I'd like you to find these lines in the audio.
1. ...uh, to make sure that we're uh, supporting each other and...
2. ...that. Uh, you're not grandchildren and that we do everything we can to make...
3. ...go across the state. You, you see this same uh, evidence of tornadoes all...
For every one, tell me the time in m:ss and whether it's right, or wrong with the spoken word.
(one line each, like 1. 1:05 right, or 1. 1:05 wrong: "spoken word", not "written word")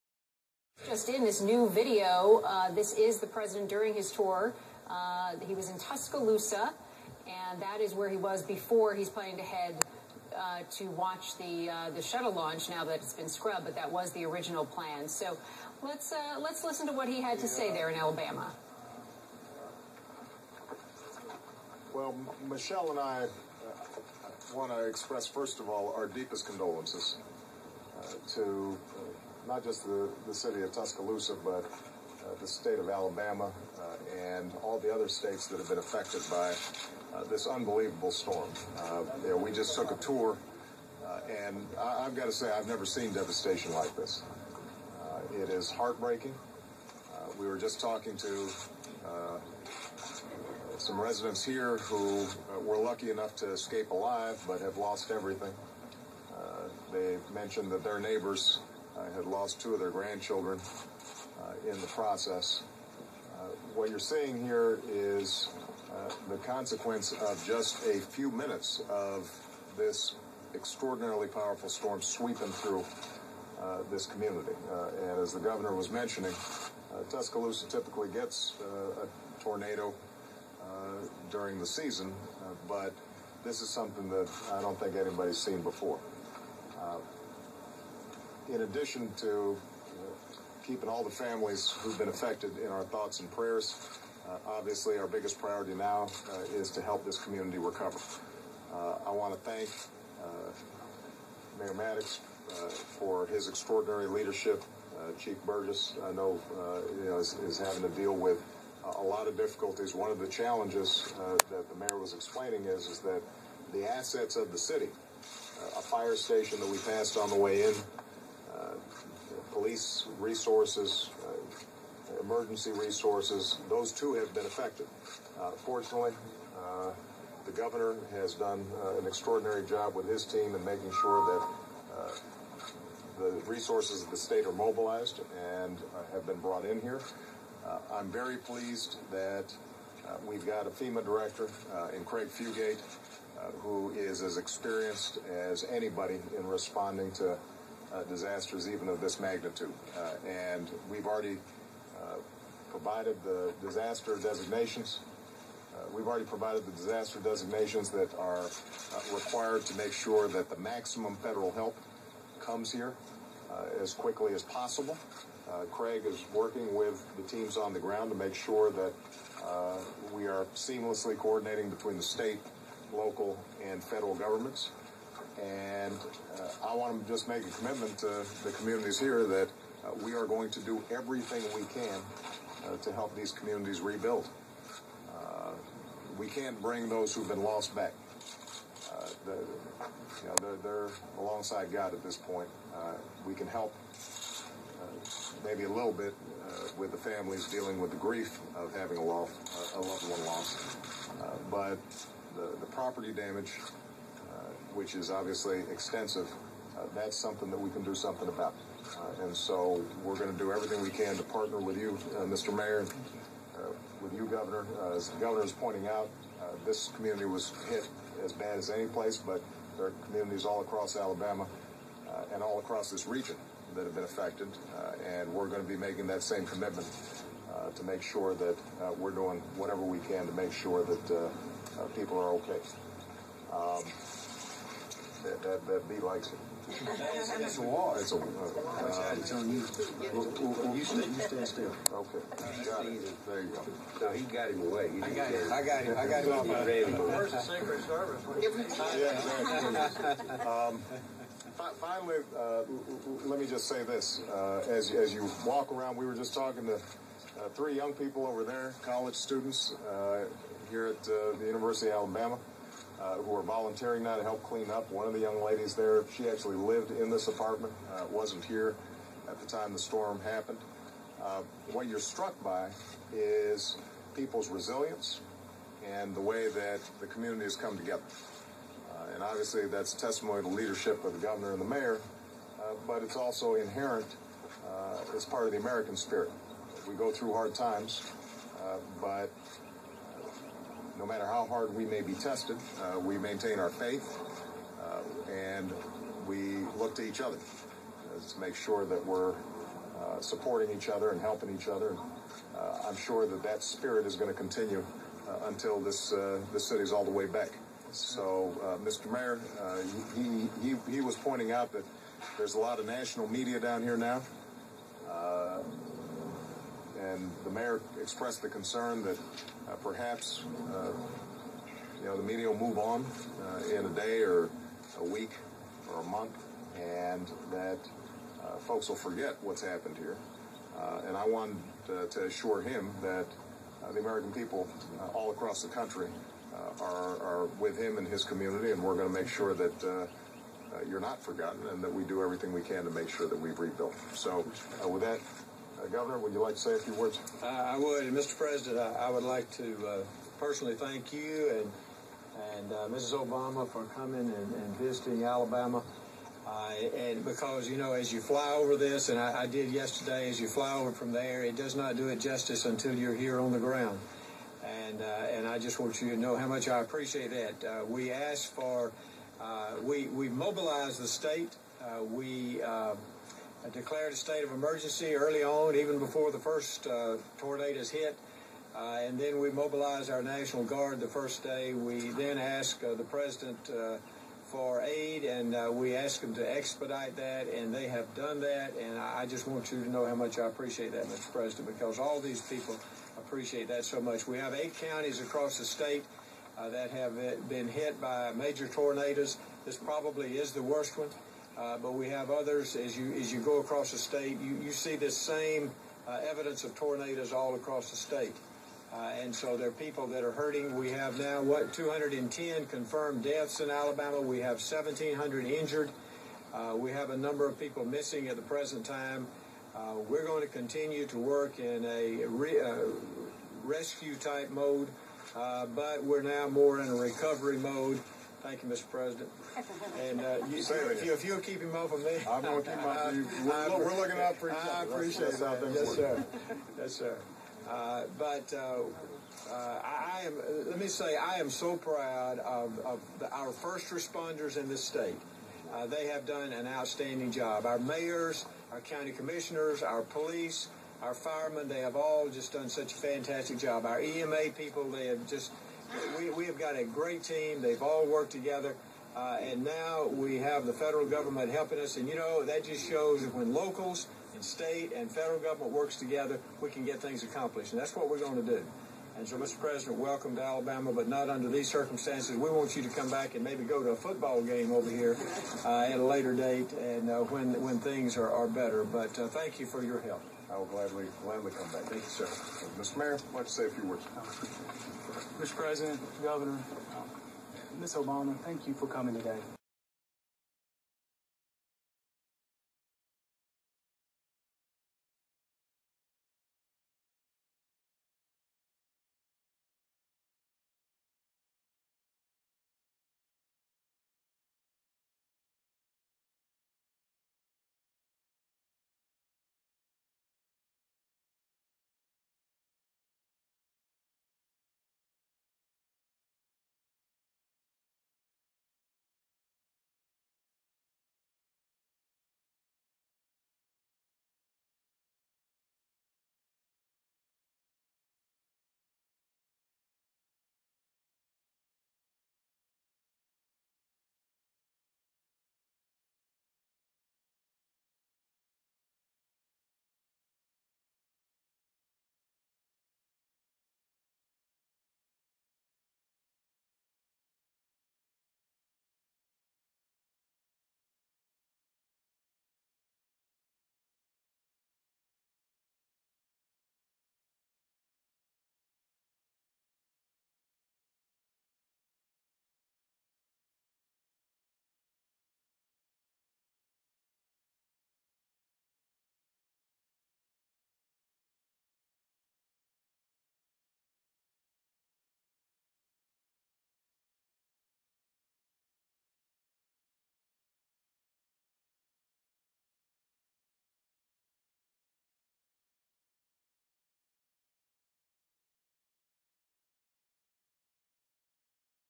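1. 4:57 right
2. 5:39 wrong: "forgotten", not "grandchildren"
3. 6:43 right.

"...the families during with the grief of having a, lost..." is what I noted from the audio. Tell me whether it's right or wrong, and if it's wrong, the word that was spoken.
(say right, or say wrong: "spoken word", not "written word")
wrong: "dealing", not "during".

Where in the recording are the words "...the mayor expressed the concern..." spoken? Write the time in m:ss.
5:17.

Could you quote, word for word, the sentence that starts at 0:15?
So let's uh, let's listen to what he had to say there in Alabama.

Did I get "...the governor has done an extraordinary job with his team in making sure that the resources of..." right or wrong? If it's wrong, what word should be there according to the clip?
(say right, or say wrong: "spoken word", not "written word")
right.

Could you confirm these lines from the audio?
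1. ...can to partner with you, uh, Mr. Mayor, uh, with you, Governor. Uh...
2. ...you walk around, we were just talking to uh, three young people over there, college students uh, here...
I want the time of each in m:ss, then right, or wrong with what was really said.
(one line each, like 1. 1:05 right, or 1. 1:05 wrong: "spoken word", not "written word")
1. 3:30 right
2. 4:15 right.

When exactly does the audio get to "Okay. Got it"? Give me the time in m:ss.
4:01.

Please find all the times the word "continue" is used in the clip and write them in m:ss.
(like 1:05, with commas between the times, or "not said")
5:04, 7:00.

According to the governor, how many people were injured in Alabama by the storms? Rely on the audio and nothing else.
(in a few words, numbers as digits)
1,700.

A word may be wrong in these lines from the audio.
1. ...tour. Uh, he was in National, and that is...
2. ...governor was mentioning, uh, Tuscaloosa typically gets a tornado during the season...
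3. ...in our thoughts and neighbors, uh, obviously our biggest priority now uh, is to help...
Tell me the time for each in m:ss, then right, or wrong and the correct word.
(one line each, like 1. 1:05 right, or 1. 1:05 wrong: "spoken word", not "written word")
1. 0:04 wrong: "Tuscaloosa", not "National"
2. 1:15 right
3. 1:32 wrong: "prayers", not "neighbors".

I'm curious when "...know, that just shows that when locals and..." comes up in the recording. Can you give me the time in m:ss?
7:42.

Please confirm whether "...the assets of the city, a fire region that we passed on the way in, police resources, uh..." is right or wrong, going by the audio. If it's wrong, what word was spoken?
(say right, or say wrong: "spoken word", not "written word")
wrong: "station", not "region".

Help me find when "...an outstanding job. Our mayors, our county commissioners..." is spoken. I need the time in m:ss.
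7:26.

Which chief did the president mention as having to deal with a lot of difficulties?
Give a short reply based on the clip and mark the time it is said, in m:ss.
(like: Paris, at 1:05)
Burgess, at 1:45.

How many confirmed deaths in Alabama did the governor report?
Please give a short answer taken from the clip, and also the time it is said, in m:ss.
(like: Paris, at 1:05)
210, at 6:51.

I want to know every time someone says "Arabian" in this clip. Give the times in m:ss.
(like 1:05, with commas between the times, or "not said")
not said.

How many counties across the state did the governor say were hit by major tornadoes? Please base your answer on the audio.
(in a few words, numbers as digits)
8.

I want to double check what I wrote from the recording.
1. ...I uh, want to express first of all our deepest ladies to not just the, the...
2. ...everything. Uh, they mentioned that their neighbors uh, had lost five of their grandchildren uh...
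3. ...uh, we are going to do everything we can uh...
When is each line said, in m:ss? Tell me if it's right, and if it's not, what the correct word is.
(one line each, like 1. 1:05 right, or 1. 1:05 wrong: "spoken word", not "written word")
1. 0:22 wrong: "condolences", not "ladies"
2. 0:55 wrong: "two", not "five"
3. 2:59 right.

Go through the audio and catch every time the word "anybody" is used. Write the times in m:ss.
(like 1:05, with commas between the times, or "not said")
1:24, 2:25.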